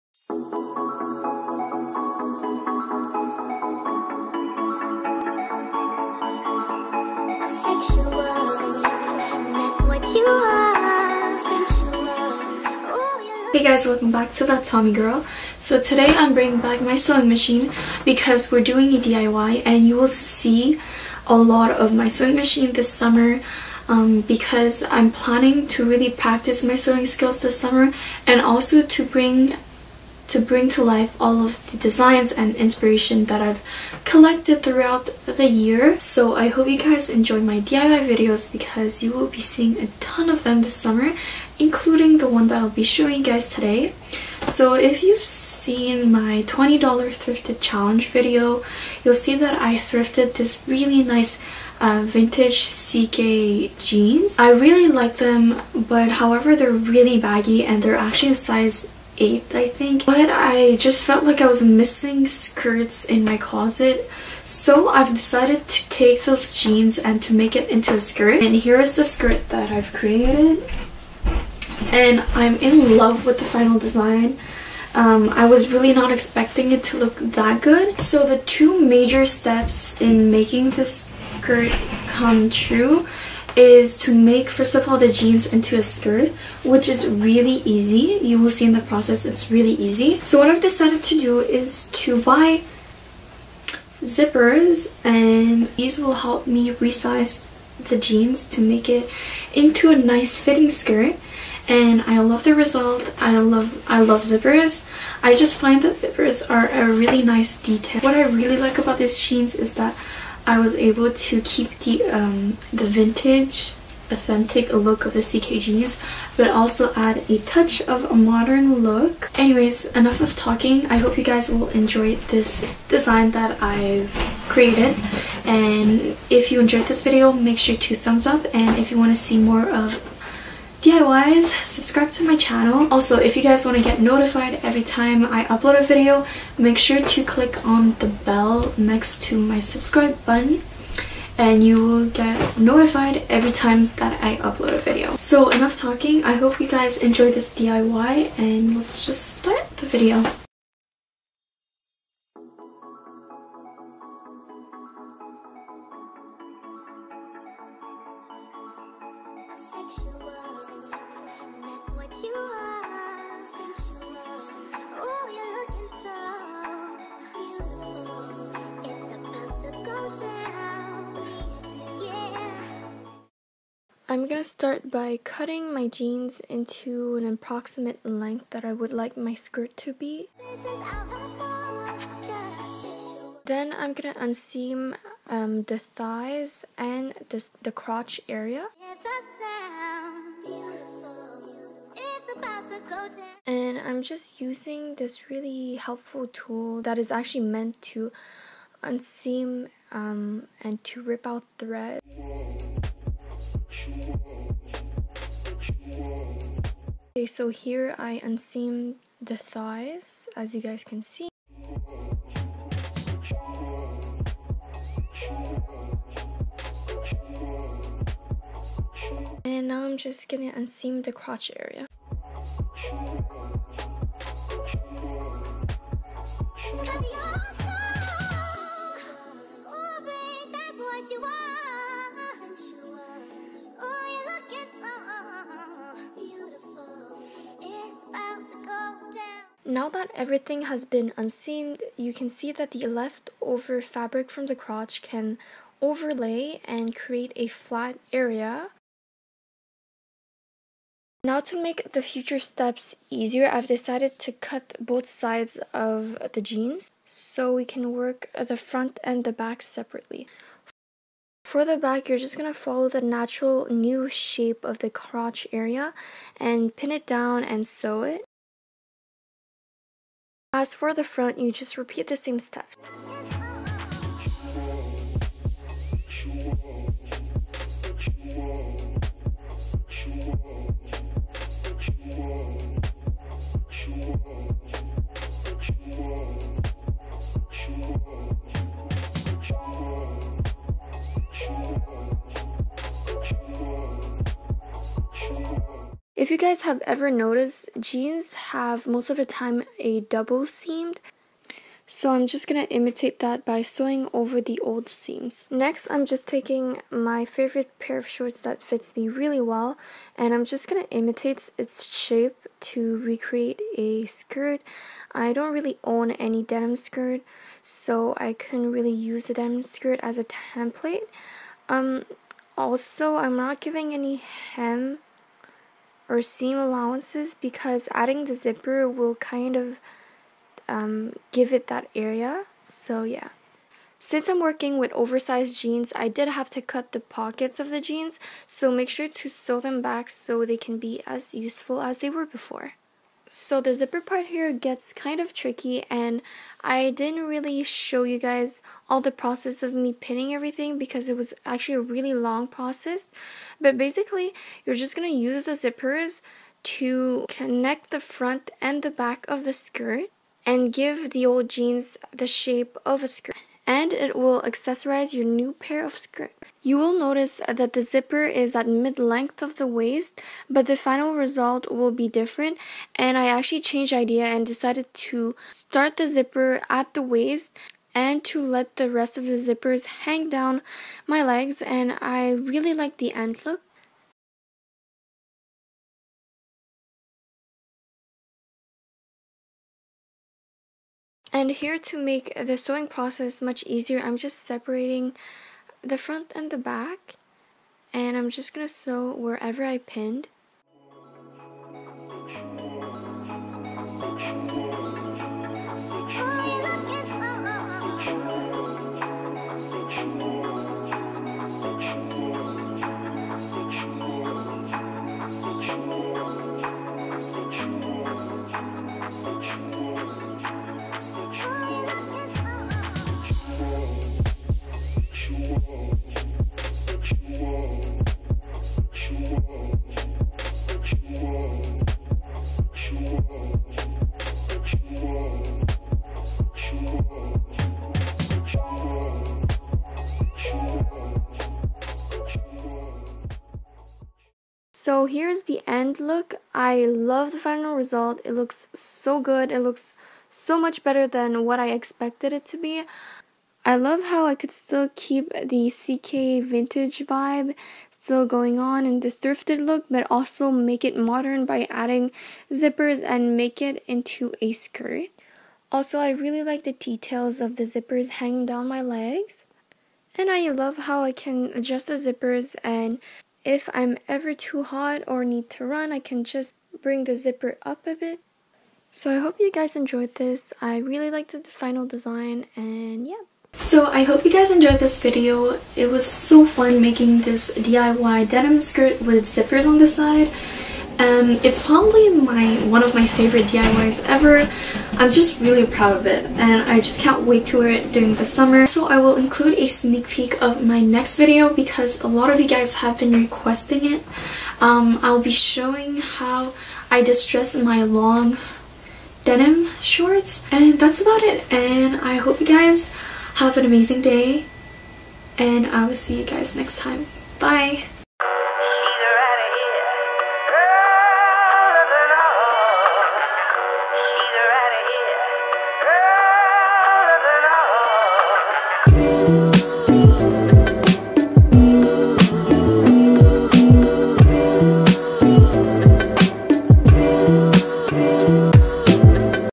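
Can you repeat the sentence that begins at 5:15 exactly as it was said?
I don't really own any denim skirt, so I couldn't really use a denim skirt as a template.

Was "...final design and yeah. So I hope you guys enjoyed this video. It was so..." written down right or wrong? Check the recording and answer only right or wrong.
right.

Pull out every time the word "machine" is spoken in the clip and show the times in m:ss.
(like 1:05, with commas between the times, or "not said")
0:17, 0:22.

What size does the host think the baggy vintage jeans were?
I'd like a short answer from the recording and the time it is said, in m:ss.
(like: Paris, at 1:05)
8, at 0:58.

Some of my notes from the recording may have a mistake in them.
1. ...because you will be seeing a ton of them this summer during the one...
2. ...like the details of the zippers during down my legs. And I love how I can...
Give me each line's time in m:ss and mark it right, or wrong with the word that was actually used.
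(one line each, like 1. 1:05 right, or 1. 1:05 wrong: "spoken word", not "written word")
1. 0:38 wrong: "including", not "during"
2. 7:46 wrong: "hanging", not "during".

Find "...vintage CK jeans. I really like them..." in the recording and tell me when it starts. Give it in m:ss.
0:52.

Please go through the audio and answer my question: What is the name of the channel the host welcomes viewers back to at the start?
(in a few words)
That Tommy Girl.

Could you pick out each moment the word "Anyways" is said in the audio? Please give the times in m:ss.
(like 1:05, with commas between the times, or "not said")
1:59.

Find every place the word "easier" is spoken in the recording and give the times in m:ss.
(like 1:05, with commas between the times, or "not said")
4:13, 6:33.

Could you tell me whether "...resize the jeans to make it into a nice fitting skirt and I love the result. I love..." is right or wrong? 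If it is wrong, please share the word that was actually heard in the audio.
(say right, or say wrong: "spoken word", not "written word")
right.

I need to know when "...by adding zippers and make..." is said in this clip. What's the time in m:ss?
7:41.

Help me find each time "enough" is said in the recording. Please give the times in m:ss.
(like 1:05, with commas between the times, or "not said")
1:59, 2:25.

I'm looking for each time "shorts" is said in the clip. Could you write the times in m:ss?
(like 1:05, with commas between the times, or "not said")
5:08, 8:29.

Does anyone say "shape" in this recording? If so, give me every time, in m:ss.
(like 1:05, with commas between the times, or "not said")
4:24, 5:11, 6:02.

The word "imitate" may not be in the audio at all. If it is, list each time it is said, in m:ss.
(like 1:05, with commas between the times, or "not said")
5:02, 5:10.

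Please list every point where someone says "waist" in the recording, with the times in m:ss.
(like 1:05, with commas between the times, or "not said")
6:09, 6:17.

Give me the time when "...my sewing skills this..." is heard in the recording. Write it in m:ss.
0:26.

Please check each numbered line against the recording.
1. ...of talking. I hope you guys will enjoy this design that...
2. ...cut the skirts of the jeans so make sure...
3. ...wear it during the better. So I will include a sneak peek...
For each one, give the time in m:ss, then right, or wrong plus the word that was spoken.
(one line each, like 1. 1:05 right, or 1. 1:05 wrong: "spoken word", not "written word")
1. 2:00 right
2. 5:36 wrong: "pockets", not "skirts"
3. 8:17 wrong: "summer", not "better".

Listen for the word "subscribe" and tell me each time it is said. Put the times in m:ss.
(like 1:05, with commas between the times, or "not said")
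2:11, 2:19.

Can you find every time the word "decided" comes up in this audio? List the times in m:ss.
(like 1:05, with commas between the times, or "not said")
1:05, 1:30, 4:13, 6:14.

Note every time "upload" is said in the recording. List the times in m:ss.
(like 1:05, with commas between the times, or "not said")
2:15, 2:24.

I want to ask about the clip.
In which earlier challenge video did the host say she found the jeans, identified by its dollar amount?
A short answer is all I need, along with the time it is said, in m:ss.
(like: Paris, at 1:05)
$20 thrifted challenge, at 0:46.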